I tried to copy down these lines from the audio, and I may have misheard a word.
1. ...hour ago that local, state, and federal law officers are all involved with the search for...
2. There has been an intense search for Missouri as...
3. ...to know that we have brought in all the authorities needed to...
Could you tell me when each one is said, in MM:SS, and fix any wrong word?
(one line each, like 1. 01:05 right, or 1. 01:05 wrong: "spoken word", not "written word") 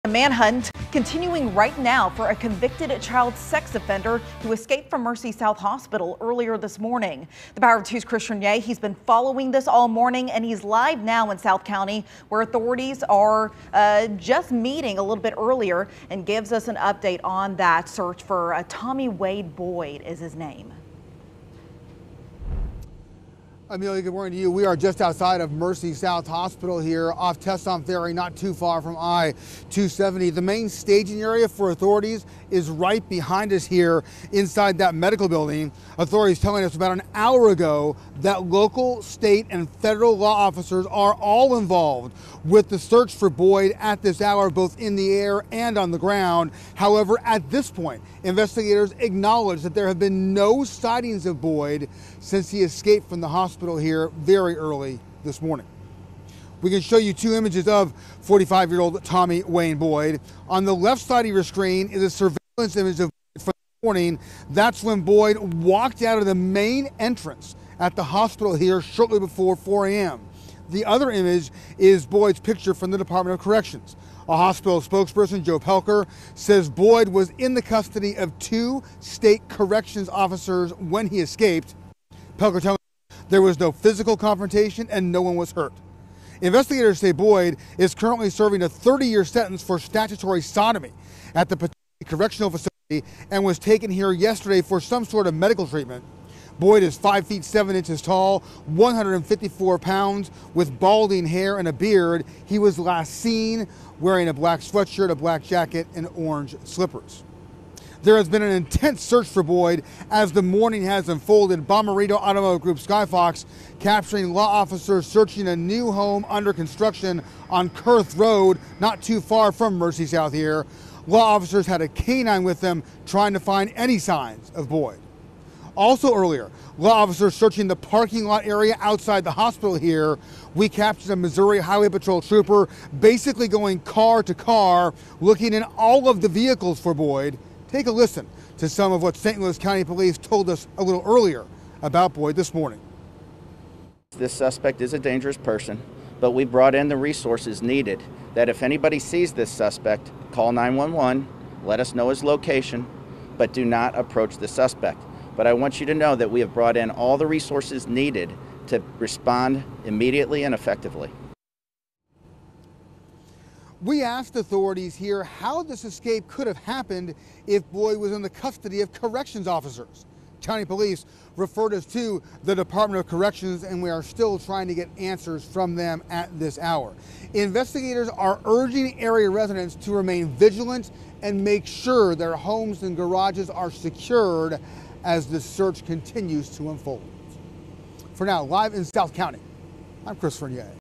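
1. 00:37 right
2. 01:48 wrong: "Boyd", not "Missouri"
3. 02:35 wrong: "resources", not "authorities".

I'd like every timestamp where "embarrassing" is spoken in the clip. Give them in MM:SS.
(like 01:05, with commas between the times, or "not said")
not said.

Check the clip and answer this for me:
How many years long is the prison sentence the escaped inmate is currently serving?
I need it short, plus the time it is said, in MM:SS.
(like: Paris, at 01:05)
30, at 01:28.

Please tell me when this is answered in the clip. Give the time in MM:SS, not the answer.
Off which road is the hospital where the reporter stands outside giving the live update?
00:27.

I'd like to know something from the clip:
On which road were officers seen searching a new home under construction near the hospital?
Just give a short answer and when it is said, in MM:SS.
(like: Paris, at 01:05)
Kurth Road, at 01:57.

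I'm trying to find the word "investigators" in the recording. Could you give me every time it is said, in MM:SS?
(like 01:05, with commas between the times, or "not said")
00:48, 01:26, 02:57.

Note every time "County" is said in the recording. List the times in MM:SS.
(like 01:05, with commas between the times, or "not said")
00:11, 02:19, 02:50, 03:09.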